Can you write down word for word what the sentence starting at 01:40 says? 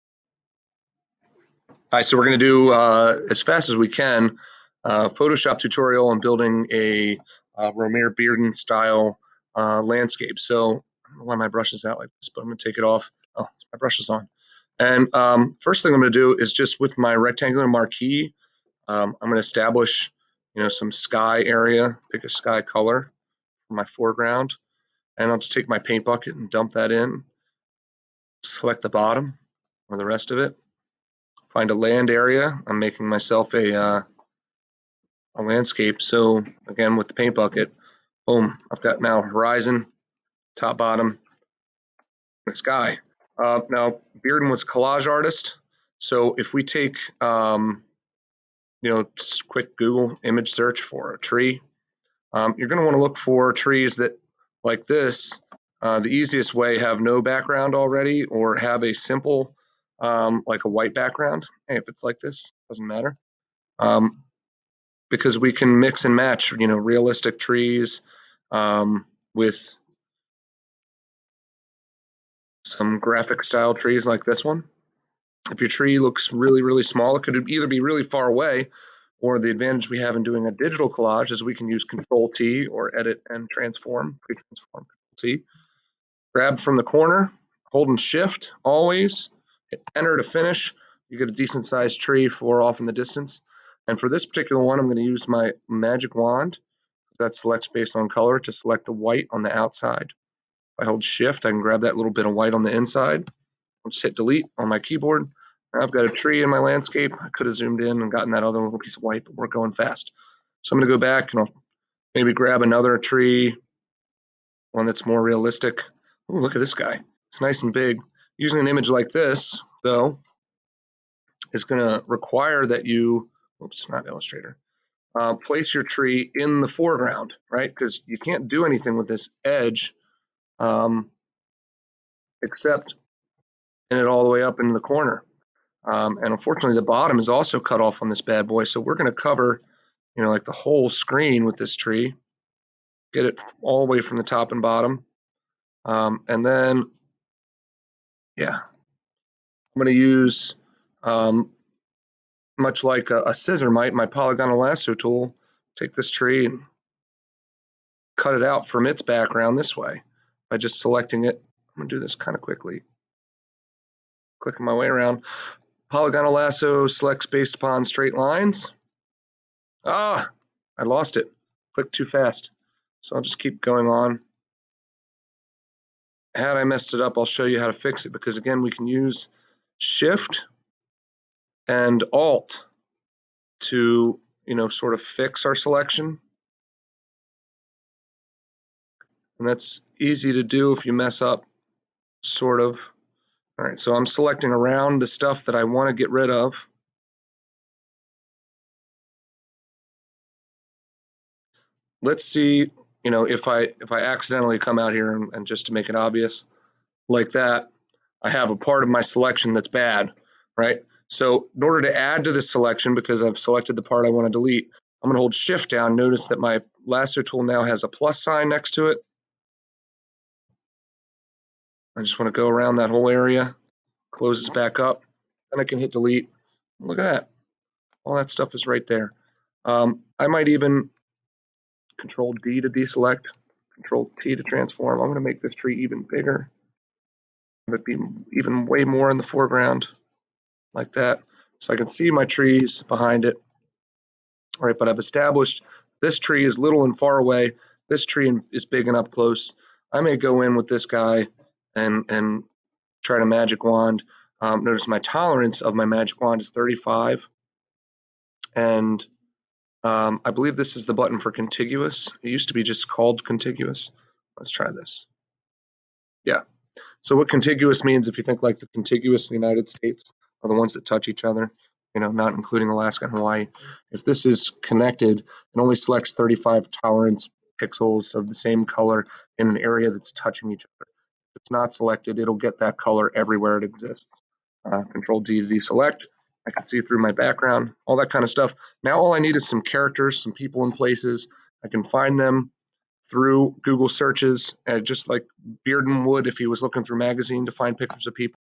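If I hold shift, I can grab that little bit of white on the inside.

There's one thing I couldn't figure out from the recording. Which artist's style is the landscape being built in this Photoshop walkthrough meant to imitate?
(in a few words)
Romare Bearden.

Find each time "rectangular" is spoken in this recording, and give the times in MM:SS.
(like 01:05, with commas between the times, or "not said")
00:17.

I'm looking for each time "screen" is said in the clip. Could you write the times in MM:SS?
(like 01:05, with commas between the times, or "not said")
02:20.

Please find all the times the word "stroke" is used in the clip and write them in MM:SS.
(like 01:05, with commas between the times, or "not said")
not said.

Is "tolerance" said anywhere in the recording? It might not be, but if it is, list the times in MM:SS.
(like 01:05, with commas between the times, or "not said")
04:14, 04:36.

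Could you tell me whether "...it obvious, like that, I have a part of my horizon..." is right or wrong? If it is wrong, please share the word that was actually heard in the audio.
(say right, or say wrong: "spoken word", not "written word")
wrong: "selection", not "horizon".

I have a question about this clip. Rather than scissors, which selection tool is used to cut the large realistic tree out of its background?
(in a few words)
polygonal lasso tool.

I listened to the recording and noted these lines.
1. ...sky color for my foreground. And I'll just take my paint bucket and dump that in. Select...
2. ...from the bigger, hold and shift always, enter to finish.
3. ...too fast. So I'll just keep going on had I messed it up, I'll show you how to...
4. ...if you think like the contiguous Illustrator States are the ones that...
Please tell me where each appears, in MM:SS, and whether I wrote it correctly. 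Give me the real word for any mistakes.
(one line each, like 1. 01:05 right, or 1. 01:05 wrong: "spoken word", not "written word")
1. 00:22 right
2. 01:26 wrong: "corner", not "bigger"
3. 02:51 right
4. 04:28 wrong: "United", not "Illustrator".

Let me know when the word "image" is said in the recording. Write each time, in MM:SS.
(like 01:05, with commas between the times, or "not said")
00:50, 01:58.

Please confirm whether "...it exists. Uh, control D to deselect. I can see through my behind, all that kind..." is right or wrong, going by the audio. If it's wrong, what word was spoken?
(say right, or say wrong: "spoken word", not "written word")
wrong: "background", not "behind".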